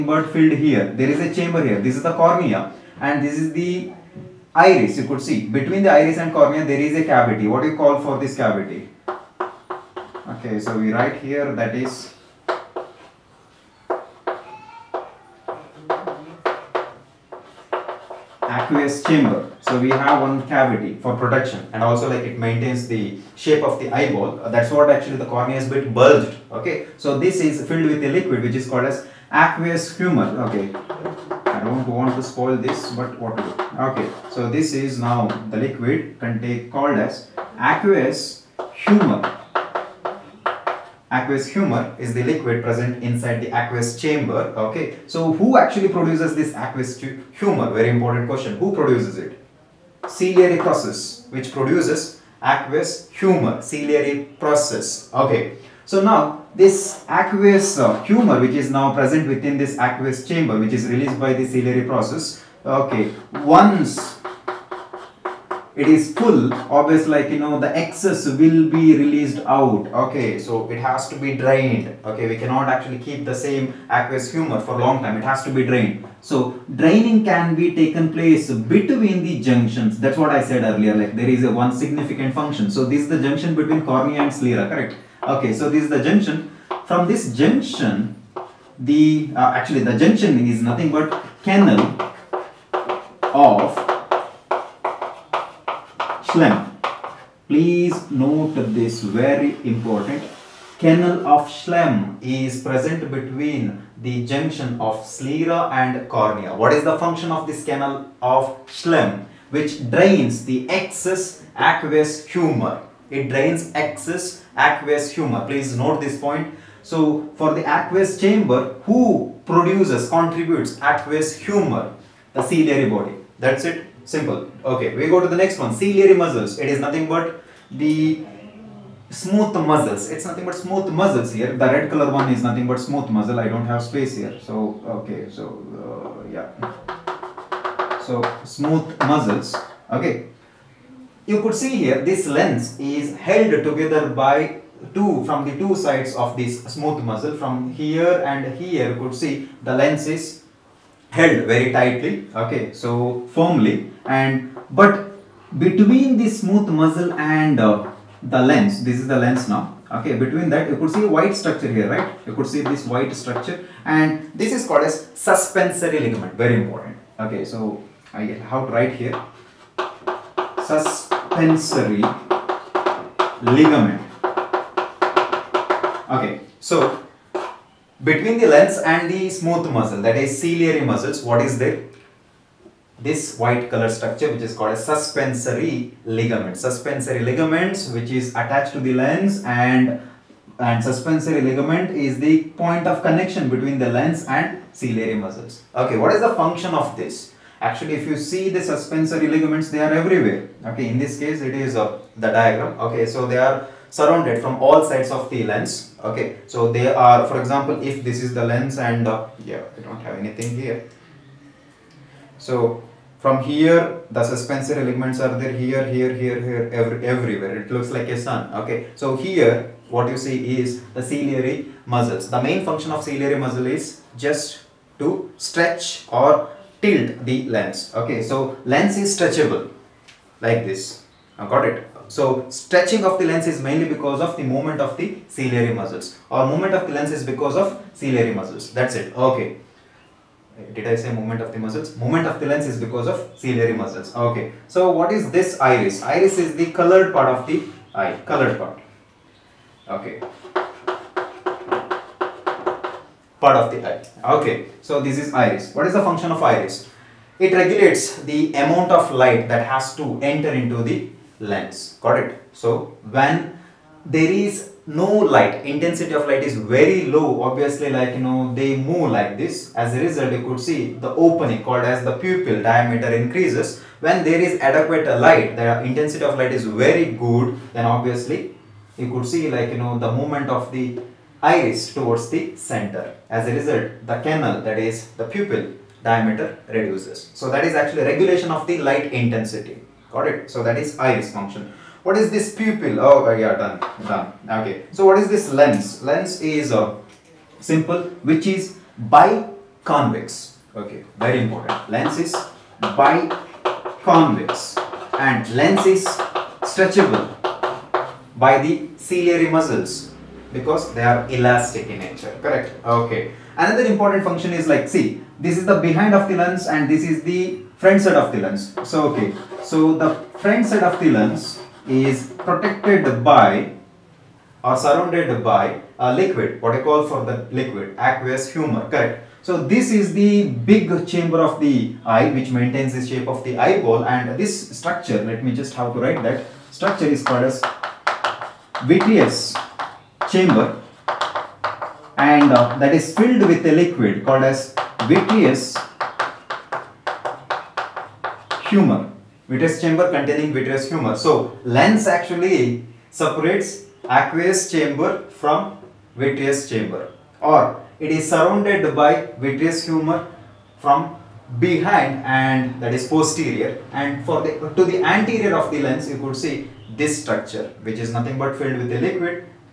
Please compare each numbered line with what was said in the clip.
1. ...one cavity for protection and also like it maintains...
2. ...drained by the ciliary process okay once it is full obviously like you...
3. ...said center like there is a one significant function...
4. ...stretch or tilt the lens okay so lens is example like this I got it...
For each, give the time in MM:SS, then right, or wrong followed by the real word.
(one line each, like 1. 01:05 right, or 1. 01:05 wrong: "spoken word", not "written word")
1. 00:20 right
2. 01:00 wrong: "released", not "drained"
3. 01:20 wrong: "earlier", not "center"
4. 03:45 wrong: "stretchable", not "example".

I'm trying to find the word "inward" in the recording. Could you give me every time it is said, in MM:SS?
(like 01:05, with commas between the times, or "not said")
not said.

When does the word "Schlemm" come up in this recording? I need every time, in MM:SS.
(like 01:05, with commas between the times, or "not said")
01:36, 01:41, 01:48.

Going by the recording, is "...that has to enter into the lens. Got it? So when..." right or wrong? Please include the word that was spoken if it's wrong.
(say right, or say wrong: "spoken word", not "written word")
right.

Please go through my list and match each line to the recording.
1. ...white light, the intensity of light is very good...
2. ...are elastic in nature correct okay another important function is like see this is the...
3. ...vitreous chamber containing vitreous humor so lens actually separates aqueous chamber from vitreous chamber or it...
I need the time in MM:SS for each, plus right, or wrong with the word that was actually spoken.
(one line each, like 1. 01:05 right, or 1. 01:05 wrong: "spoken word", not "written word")
1. 04:34 wrong: "adequate", not "white"
2. 05:11 right
3. 05:49 right.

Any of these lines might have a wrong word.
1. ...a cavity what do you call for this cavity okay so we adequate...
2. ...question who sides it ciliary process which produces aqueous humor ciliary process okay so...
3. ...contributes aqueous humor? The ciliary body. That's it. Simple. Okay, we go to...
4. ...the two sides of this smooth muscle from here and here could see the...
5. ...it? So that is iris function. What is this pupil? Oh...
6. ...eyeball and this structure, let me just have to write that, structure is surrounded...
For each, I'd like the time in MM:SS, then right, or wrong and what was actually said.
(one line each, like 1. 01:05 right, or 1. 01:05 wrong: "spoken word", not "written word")
1. 00:06 wrong: "write", not "adequate"
2. 00:48 wrong: "produces", not "sides"
3. 02:00 right
4. 02:25 right
5. 04:50 right
6. 05:33 wrong: "called", not "surrounded".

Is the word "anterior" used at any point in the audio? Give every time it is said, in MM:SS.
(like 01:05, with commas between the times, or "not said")
06:05.